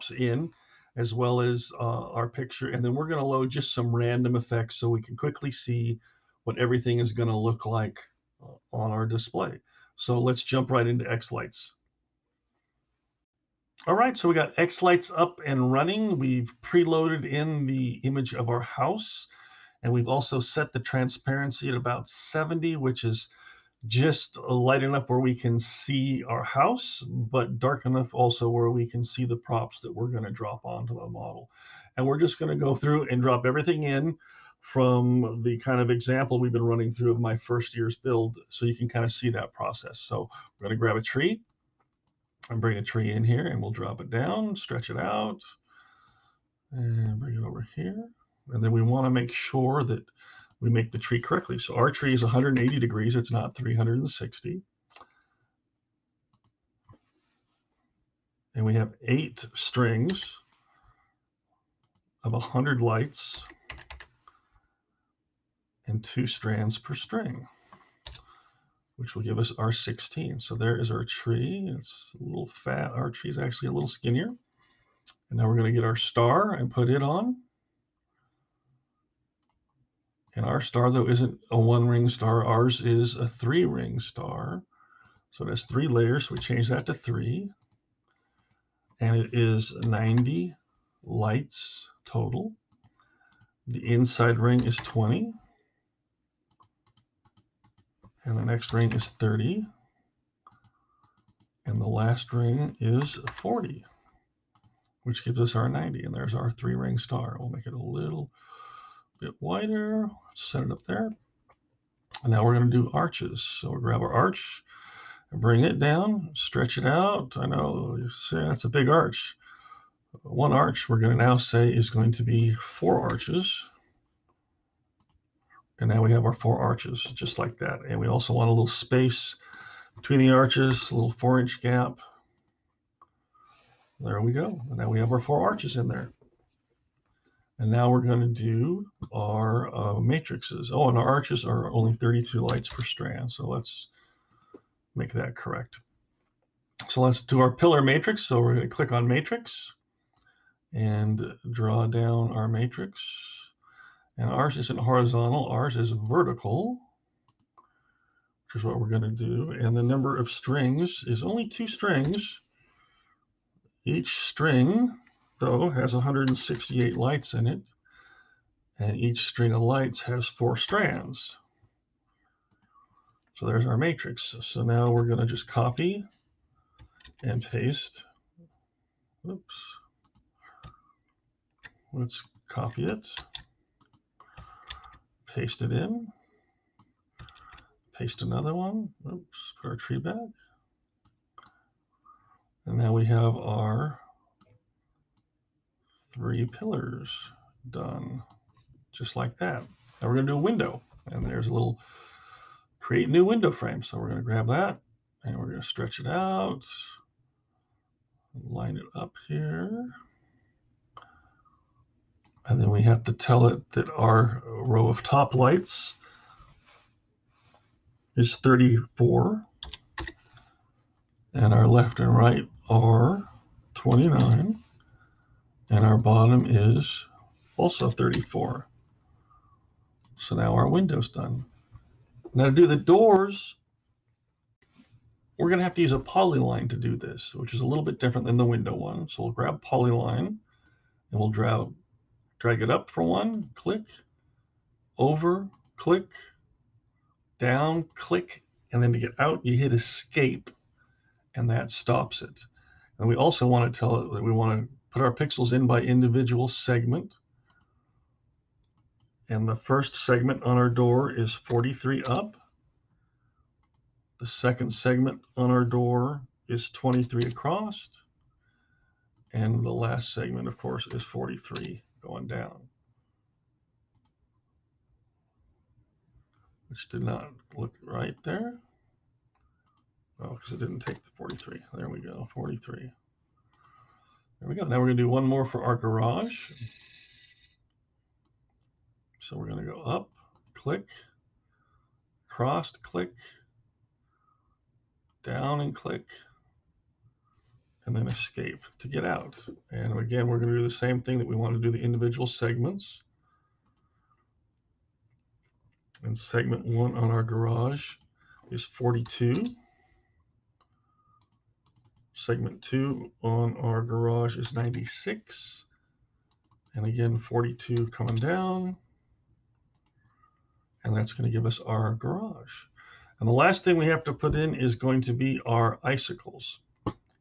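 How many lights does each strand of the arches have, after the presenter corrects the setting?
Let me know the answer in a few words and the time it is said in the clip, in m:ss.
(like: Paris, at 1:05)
32, at 2:21.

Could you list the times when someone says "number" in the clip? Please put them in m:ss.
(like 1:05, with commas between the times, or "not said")
2:39.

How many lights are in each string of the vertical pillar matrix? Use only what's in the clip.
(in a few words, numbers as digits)
168.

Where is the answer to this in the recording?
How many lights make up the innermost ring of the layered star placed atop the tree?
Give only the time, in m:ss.
1:34.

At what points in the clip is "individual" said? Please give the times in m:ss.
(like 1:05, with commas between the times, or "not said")
4:15, 5:01.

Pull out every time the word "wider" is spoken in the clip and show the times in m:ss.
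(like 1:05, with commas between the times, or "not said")
1:49.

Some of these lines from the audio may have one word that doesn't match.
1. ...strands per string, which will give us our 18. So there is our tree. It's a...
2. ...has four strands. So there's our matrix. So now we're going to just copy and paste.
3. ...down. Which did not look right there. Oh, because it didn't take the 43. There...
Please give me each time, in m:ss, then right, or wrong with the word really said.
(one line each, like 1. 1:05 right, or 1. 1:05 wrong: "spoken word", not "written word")
1. 1:06 wrong: "16", not "18"
2. 2:50 right
3. 4:32 right.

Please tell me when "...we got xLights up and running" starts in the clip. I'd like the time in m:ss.
0:14.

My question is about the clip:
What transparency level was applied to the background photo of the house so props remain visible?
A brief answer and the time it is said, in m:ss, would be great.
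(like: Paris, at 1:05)
70, at 0:22.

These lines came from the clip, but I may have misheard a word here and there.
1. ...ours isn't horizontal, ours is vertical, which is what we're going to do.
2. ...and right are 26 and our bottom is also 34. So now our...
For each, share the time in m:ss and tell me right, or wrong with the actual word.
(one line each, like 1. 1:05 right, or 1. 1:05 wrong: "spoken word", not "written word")
1. 2:34 right
2. 3:41 wrong: "29", not "26".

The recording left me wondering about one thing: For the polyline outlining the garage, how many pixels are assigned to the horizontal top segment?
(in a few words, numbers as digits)
96.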